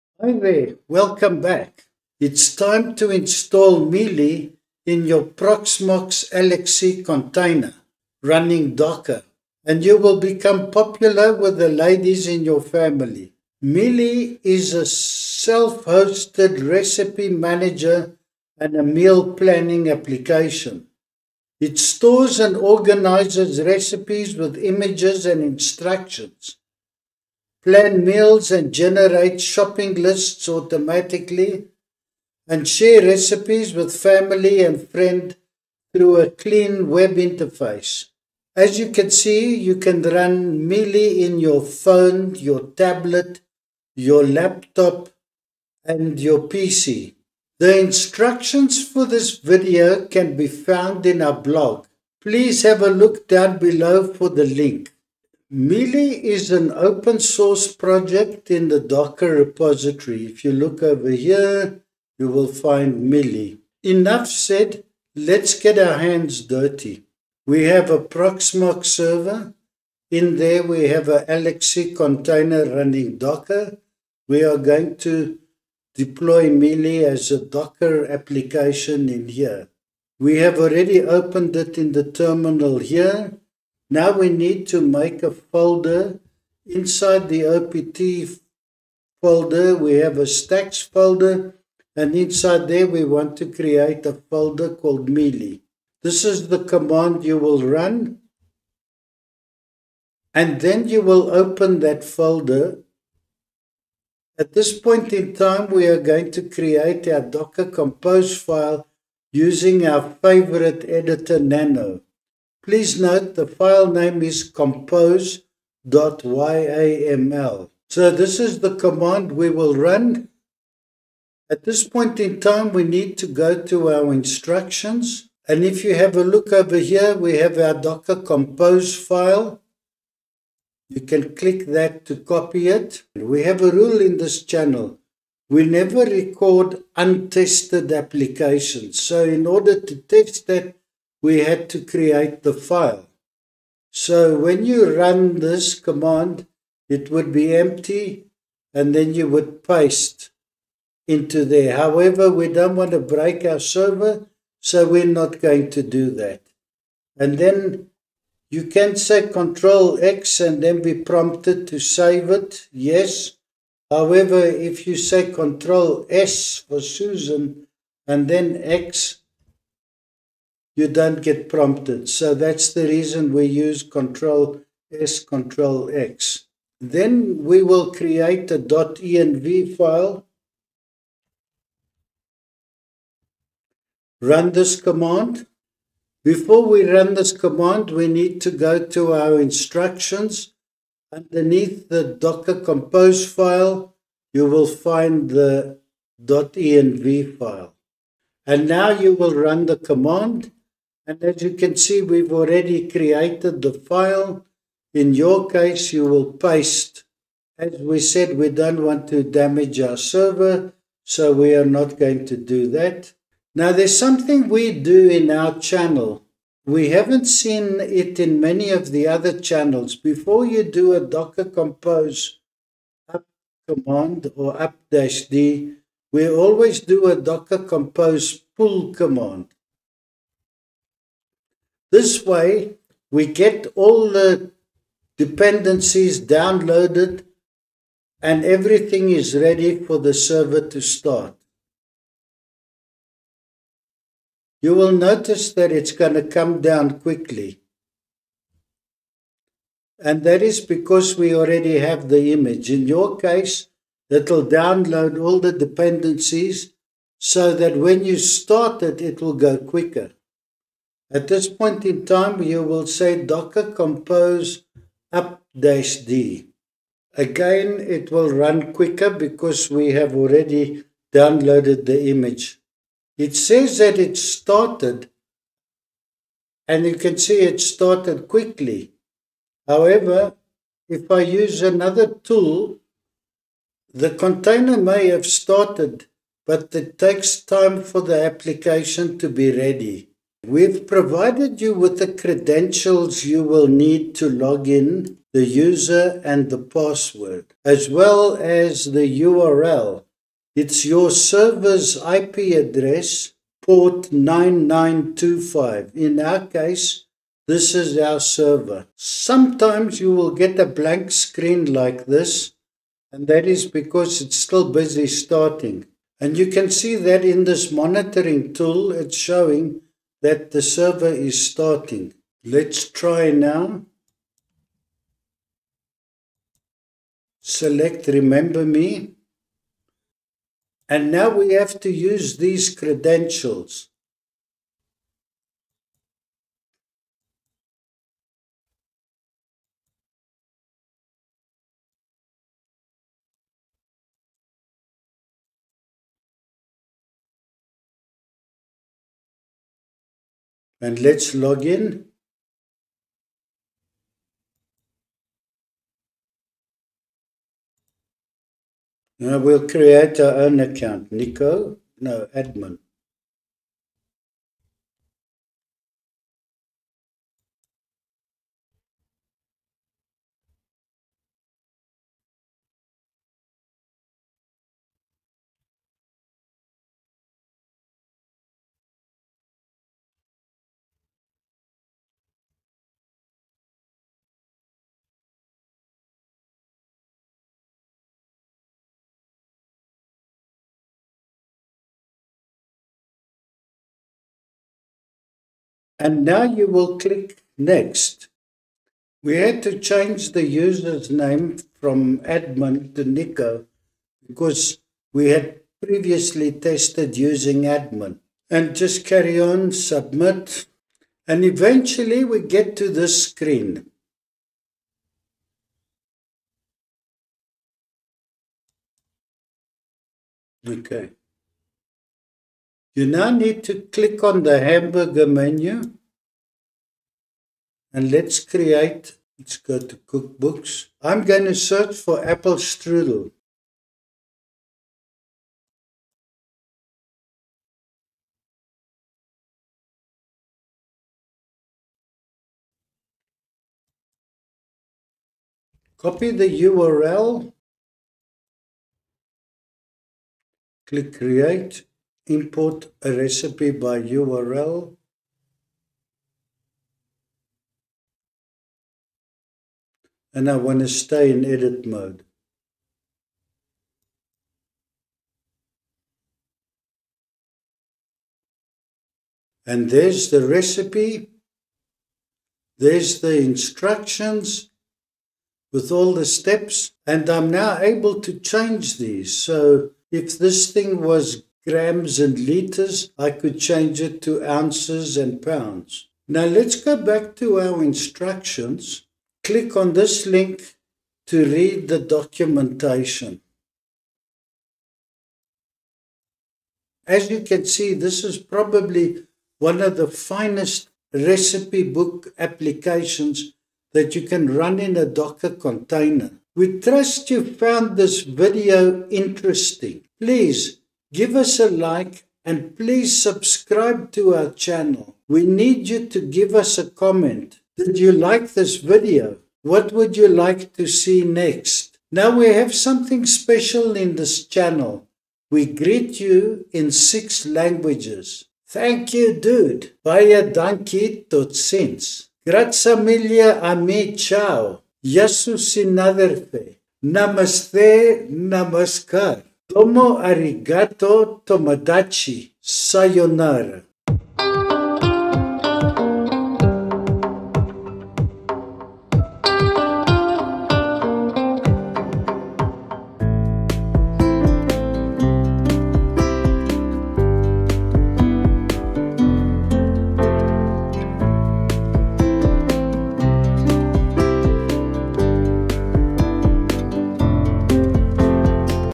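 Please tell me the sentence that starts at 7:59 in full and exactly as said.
So if this thing was grams and liters.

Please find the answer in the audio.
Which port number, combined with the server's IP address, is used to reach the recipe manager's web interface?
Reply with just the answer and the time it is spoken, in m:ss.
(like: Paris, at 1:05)
9925, at 5:03.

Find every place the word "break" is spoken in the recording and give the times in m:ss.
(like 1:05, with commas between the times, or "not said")
2:32.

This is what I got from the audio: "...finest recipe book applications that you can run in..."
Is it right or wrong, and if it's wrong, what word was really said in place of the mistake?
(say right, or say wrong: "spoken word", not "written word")
right.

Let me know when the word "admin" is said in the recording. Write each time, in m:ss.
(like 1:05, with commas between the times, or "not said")
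6:02, 6:42, 6:47.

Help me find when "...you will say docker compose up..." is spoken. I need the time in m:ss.
4:22.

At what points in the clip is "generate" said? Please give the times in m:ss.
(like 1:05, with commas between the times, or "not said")
0:28.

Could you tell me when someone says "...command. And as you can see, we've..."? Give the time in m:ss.
3:19.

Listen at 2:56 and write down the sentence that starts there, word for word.
Then we will create a .env file.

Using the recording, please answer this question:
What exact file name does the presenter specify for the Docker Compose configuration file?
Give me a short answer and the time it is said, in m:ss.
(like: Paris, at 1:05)
compose.yaml, at 1:54.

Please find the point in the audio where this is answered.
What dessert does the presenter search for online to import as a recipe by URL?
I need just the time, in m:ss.
7:12.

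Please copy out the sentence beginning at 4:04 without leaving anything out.
You will notice that it's going to come down quickly.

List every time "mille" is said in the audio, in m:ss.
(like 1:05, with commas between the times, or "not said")
8:53.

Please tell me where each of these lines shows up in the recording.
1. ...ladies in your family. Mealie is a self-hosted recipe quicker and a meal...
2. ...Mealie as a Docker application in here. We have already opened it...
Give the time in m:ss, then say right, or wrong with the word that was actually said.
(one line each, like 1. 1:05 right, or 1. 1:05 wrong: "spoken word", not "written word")
1. 0:11 wrong: "manager", not "quicker"
2. 1:16 right.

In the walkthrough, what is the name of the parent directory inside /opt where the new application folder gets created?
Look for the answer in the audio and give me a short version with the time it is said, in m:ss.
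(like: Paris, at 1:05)
stacks, at 1:30.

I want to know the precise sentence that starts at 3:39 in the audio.
Before you do a Docker compose up command or up dash D, we always do a Docker compose pull command.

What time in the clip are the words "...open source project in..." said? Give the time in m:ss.
0:56.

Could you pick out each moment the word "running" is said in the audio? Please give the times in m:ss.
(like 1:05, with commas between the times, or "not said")
0:08, 1:12.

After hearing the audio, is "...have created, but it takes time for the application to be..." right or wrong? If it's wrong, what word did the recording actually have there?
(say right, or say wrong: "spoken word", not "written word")
wrong: "started", not "created".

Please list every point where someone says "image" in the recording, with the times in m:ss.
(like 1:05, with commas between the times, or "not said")
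0:24, 4:12, 4:32.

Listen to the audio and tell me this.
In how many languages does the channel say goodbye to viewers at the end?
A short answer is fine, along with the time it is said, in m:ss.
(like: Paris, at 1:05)
6, at 8:46.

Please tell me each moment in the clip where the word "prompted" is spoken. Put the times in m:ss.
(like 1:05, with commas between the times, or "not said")
2:40, 2:51.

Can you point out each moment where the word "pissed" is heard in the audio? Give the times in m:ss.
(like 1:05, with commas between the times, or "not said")
not said.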